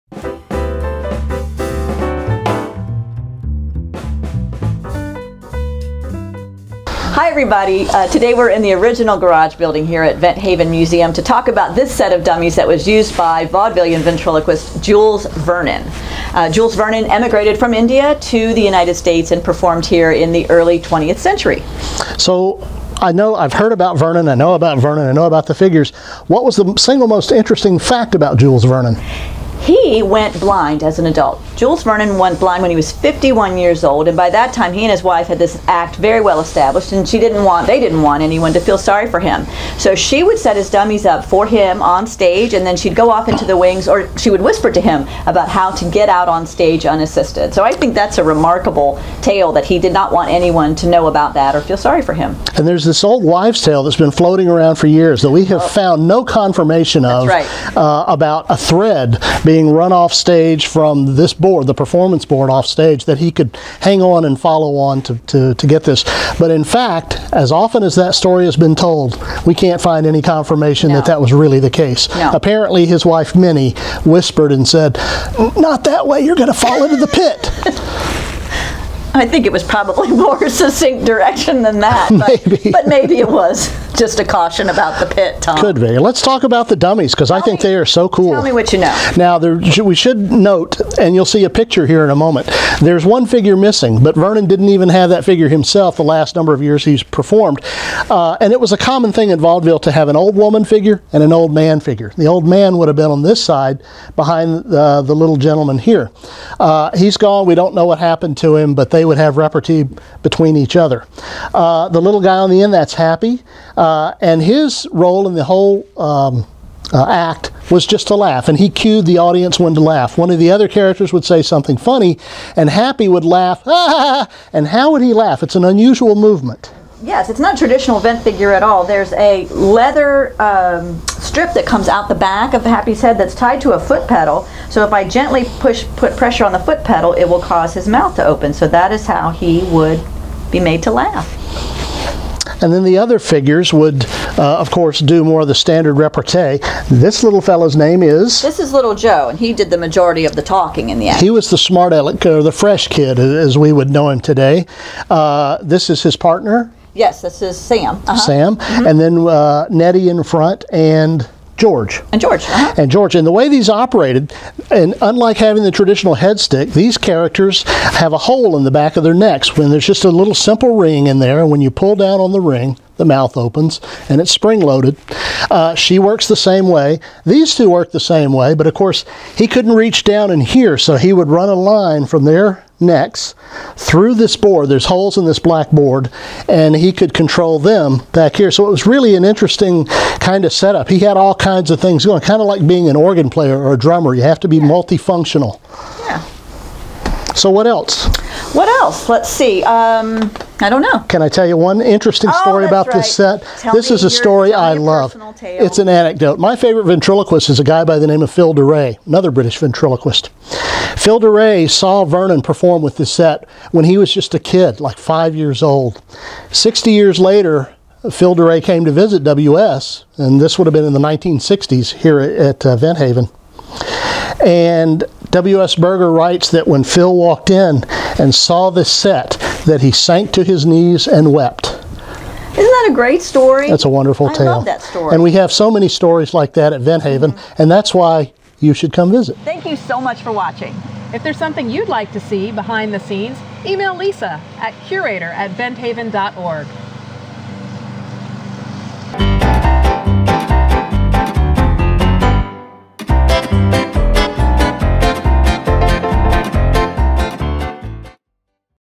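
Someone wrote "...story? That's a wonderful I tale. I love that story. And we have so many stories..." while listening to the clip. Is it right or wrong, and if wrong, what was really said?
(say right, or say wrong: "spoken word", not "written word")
right.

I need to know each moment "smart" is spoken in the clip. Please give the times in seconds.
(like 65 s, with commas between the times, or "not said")
151 s.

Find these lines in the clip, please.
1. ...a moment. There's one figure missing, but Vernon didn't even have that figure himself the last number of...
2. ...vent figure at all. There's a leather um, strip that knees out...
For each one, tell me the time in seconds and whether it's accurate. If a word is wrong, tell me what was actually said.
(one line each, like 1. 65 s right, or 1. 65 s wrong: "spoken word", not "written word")
1. 92 s right
2. 127 s wrong: "comes", not "knees".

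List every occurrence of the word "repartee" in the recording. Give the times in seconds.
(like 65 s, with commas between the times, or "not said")
109 s, 145 s.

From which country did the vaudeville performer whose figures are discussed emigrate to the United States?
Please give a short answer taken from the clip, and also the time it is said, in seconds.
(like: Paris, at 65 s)
India, at 17 s.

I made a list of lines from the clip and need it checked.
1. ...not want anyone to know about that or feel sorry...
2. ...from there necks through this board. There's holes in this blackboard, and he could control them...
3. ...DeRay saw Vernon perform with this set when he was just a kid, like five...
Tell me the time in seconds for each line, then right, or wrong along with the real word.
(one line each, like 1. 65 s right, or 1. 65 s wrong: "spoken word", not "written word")
1. 49 s right
2. 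182 s right
3. 211 s right.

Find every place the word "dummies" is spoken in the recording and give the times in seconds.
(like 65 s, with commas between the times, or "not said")
12 s, 40 s, 86 s.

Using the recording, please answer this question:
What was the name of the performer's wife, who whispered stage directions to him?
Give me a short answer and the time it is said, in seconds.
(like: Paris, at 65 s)
Minnie, at 73 s.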